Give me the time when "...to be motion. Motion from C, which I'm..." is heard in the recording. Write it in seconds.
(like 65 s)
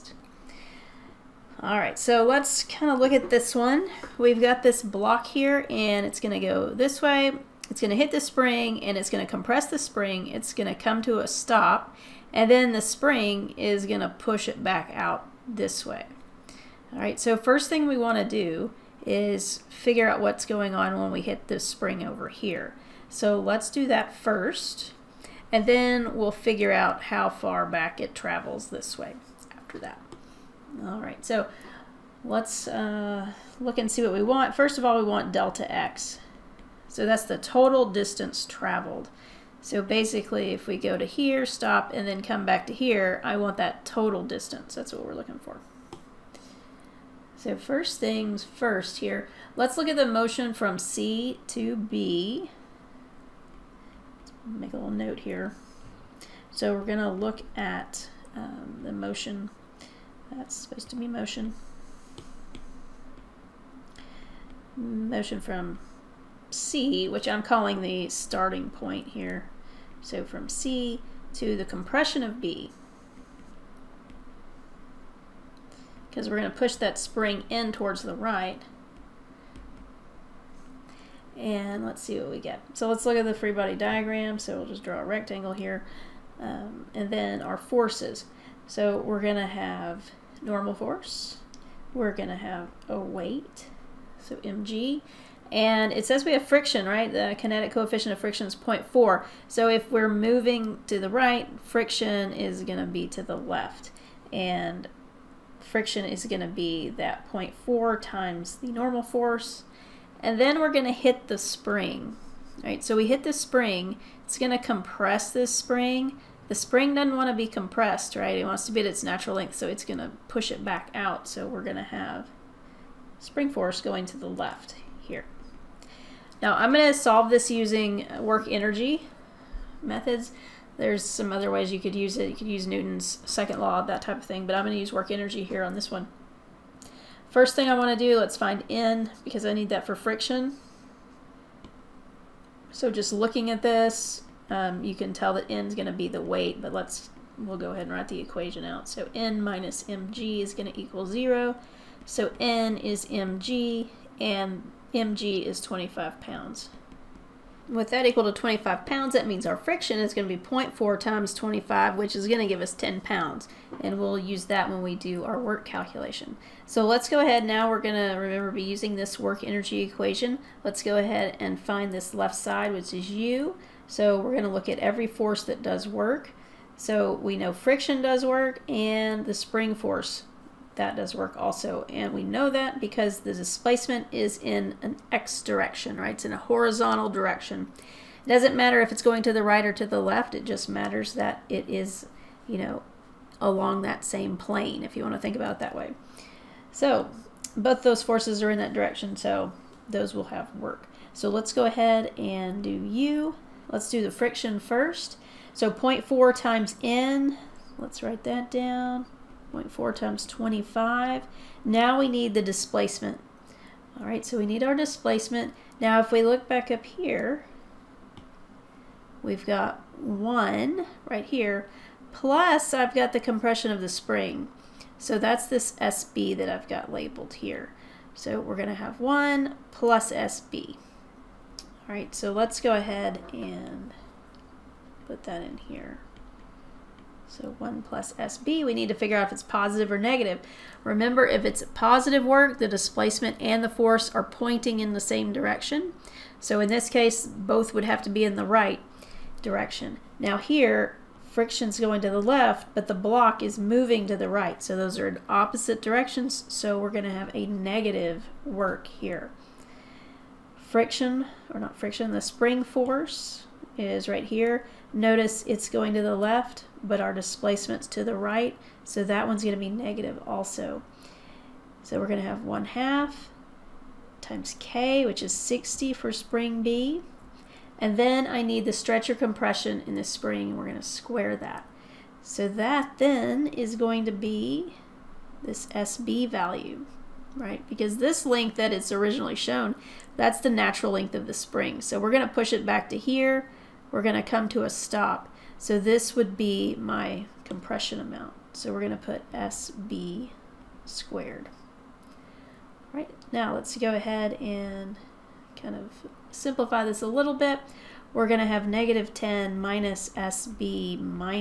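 60 s.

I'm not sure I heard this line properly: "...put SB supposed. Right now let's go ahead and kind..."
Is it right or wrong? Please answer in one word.
wrong.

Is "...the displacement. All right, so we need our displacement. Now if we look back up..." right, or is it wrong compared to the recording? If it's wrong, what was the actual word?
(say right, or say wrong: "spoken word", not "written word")
right.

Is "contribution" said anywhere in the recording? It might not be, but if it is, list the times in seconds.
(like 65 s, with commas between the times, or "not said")
not said.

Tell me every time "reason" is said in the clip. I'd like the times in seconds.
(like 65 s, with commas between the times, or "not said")
not said.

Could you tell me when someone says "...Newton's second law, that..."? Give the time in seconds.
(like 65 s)
132 s.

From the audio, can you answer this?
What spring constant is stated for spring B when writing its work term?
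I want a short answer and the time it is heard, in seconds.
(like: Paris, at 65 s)
60, at 275 s.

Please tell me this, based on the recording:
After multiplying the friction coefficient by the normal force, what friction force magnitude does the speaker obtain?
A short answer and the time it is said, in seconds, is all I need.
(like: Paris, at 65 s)
10 pounds, at 162 s.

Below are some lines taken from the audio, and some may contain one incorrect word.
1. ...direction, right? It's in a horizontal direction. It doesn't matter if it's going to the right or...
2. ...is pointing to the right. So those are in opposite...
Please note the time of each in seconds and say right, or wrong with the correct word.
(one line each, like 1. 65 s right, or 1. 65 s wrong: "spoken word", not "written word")
1. 185 s right
2. 253 s wrong: "moving", not "pointing".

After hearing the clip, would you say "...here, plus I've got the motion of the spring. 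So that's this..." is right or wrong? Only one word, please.
wrong.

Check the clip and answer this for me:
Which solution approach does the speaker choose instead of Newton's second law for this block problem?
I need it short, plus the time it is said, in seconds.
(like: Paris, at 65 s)
Work energy methods, at 128 s.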